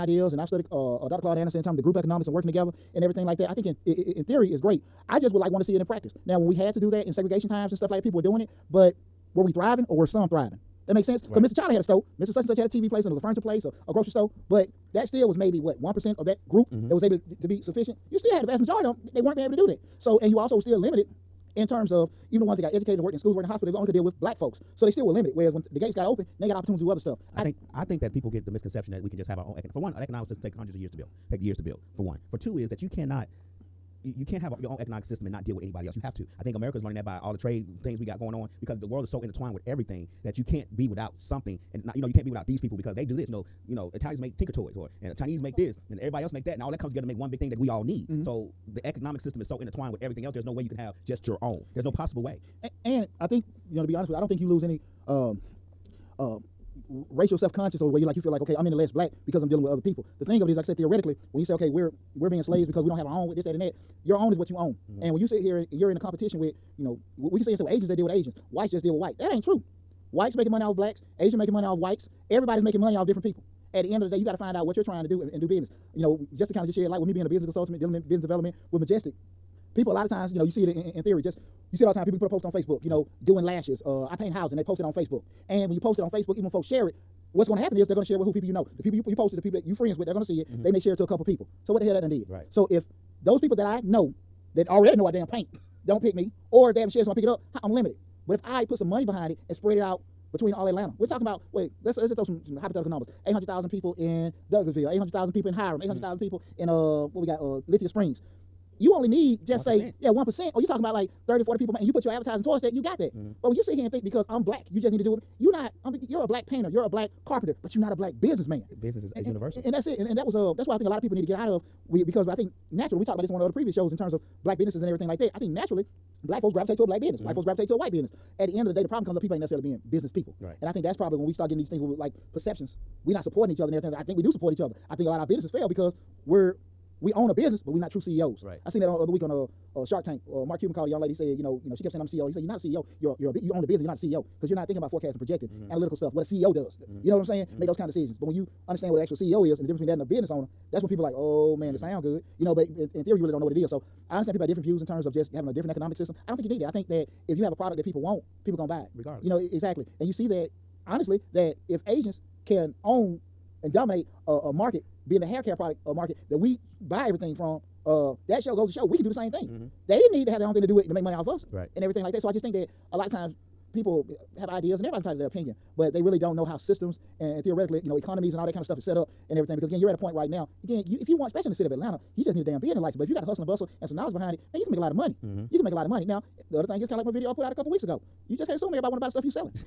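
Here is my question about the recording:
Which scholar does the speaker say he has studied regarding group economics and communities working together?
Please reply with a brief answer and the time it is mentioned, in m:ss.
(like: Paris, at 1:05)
Dr. Claude Anderson, at 0:01.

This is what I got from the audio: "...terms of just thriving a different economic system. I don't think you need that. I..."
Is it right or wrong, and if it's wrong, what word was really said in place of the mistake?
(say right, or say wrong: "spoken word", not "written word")
wrong: "having", not "thriving".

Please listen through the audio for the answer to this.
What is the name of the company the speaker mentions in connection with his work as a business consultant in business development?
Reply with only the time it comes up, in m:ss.
1:18.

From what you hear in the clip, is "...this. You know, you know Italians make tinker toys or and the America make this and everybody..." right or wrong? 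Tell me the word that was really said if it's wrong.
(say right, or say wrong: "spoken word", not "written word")
wrong: "Chinese", not "America".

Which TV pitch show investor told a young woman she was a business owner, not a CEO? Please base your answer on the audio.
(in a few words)
Mark Cuban.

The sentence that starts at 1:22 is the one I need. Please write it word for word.
People can put a post on Facebook, you know, doing lashes.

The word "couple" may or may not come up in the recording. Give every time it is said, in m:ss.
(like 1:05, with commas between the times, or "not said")
1:31, 3:07.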